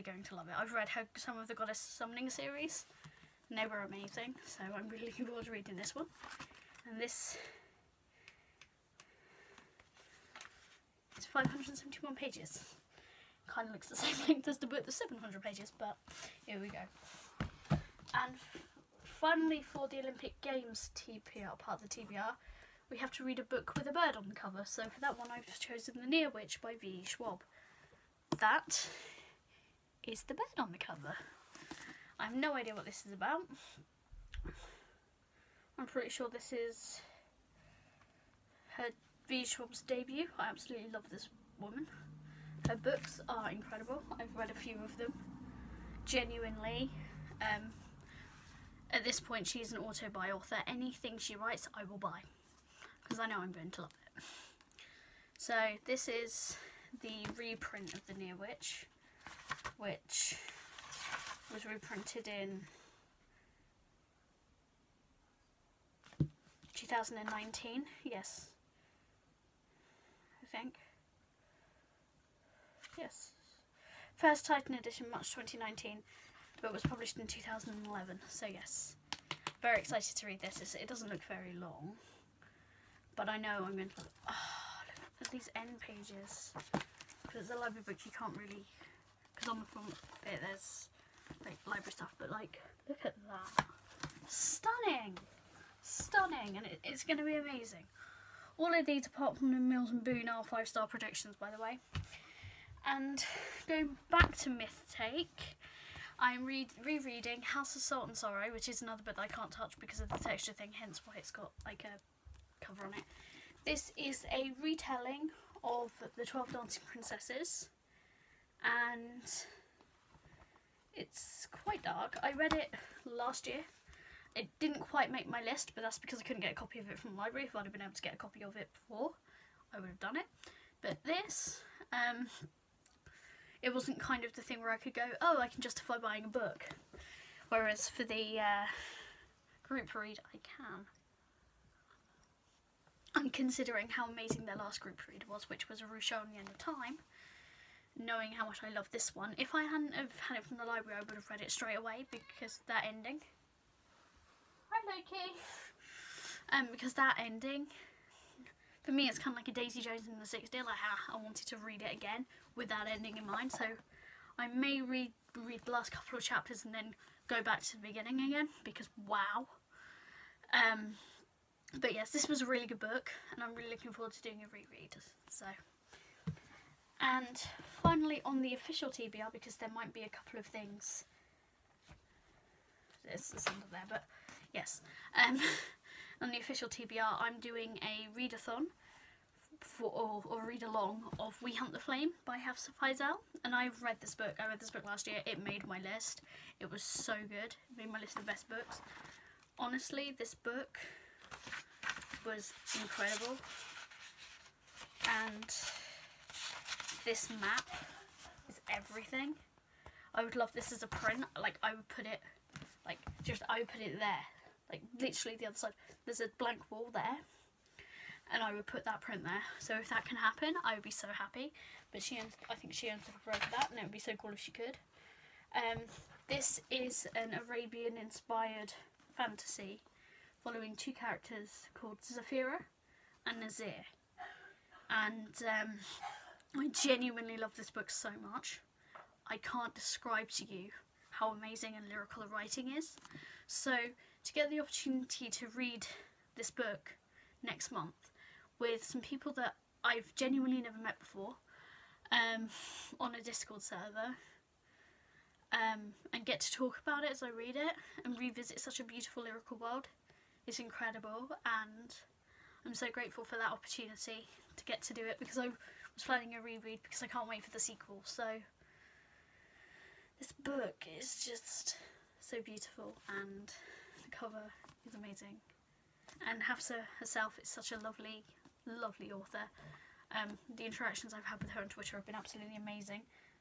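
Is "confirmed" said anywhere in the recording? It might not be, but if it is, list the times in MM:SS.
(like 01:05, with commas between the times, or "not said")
not said.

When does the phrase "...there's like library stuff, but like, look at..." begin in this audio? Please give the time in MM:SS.
01:30.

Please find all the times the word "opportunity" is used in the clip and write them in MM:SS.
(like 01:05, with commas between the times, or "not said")
04:04, 04:23.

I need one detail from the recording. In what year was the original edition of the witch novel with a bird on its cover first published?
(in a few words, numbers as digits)
2011.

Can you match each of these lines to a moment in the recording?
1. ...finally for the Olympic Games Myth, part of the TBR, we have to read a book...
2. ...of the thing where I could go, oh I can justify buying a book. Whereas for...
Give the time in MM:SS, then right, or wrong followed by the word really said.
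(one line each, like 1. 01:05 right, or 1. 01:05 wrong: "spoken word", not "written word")
1. 00:19 wrong: "TPR", not "Myth"
2. 02:14 right.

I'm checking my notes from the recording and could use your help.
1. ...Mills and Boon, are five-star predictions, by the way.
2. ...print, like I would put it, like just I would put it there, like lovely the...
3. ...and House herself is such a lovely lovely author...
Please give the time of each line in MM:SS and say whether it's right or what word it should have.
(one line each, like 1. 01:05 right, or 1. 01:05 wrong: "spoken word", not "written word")
1. 01:39 right
2. 03:30 wrong: "literally", not "lovely"
3. 04:36 wrong: "Hafsah", not "House".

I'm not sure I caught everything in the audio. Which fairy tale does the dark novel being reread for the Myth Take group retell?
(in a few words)
12 Dancing Princesses.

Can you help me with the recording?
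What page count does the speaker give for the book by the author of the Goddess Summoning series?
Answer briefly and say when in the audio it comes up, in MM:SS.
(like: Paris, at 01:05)
571, at 00:11.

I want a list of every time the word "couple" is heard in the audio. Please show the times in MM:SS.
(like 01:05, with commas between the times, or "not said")
02:45, 03:00.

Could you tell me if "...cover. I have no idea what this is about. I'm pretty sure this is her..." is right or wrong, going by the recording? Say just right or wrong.
right.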